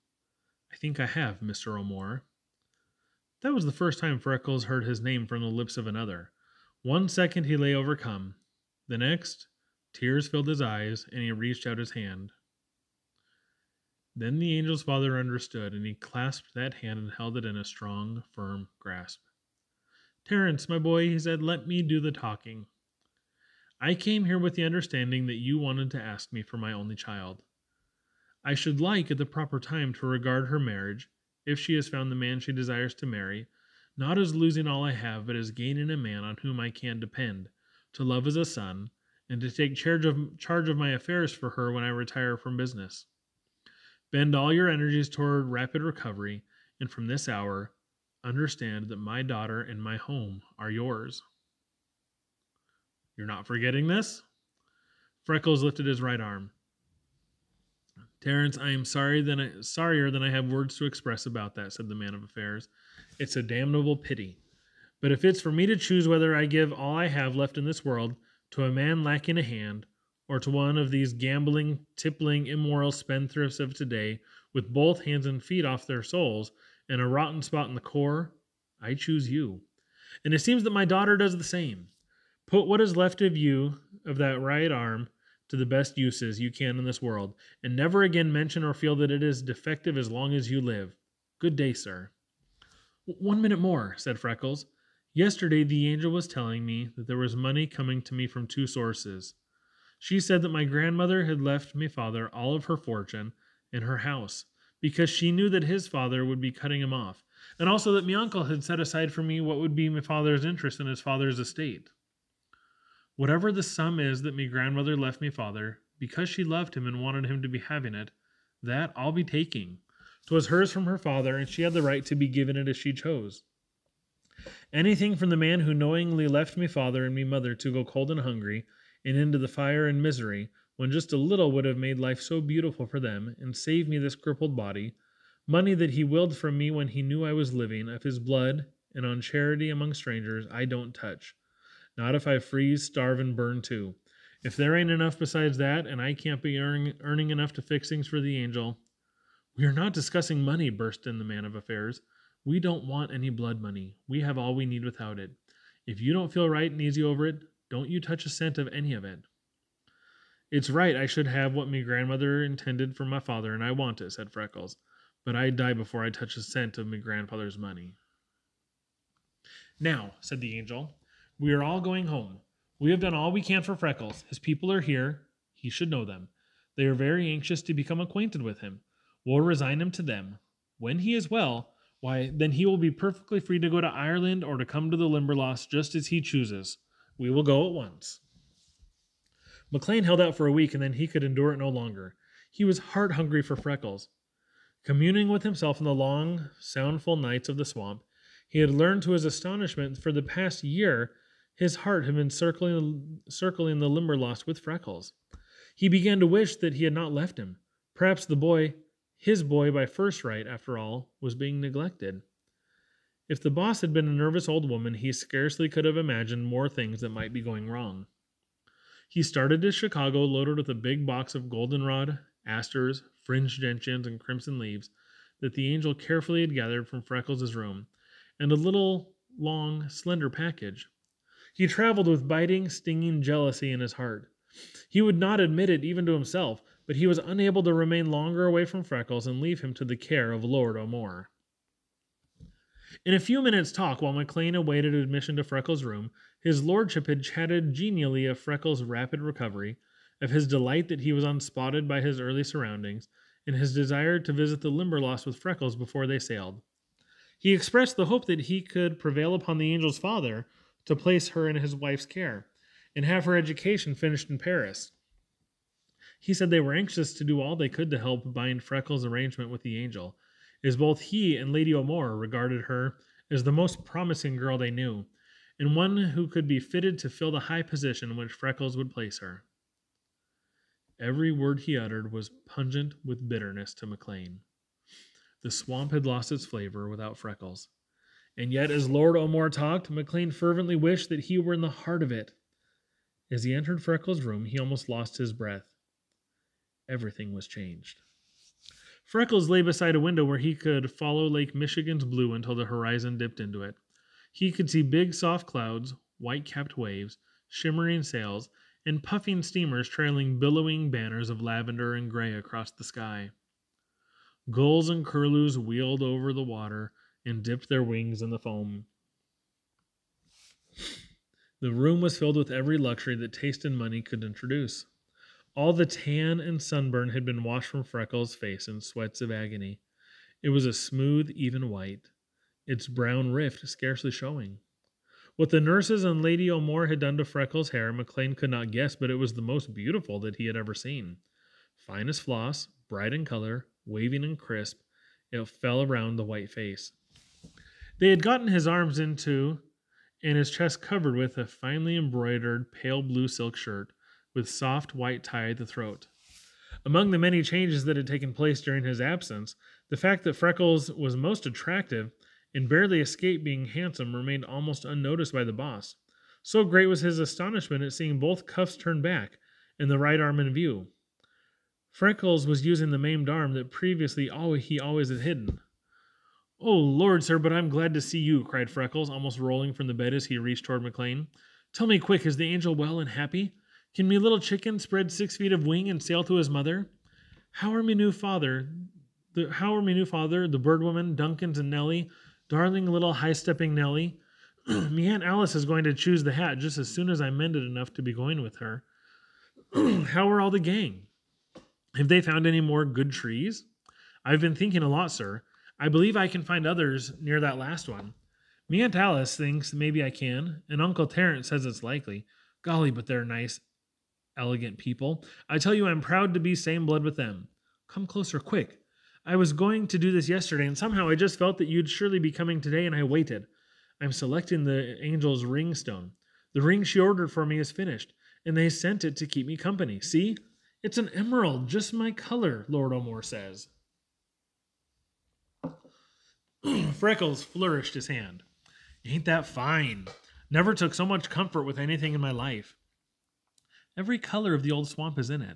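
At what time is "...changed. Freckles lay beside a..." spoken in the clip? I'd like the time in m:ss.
4:57.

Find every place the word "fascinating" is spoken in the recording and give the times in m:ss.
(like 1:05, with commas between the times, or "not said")
not said.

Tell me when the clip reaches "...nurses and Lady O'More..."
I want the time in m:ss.
5:35.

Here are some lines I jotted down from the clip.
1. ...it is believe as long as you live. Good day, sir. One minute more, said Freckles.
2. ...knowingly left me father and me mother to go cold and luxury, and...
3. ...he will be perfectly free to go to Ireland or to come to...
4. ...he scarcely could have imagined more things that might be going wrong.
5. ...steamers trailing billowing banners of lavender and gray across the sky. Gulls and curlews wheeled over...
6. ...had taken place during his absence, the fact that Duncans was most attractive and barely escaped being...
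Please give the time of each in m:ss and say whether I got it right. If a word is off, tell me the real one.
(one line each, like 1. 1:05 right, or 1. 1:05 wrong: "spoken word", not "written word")
1. 1:29 wrong: "defective", not "believe"
2. 2:05 wrong: "hungry", not "luxury"
3. 3:02 right
4. 3:34 right
5. 5:09 right
6. 5:57 wrong: "Freckles", not "Duncans".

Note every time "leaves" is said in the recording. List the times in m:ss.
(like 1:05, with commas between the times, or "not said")
3:44, 3:59.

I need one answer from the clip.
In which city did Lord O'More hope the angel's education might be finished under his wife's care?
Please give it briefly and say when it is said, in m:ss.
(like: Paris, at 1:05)
Paris, at 4:24.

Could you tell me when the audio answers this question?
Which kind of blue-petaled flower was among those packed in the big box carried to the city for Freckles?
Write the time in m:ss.
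3:43.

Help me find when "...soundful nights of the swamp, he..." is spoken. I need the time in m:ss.
3:16.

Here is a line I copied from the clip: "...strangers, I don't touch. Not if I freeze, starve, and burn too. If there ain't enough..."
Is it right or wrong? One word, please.
right.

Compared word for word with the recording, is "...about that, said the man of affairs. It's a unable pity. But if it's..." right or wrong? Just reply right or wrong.
wrong.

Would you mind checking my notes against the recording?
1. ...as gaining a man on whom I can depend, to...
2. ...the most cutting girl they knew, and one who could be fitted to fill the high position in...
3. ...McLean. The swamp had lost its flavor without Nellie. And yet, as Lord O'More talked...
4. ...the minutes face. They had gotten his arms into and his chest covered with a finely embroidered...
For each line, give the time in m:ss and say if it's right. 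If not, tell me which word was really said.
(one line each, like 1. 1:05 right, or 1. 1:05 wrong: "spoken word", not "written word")
1. 0:35 right
2. 4:33 wrong: "promising", not "cutting"
3. 4:43 wrong: "Freckles", not "Nellie"
4. 5:46 wrong: "white", not "minutes".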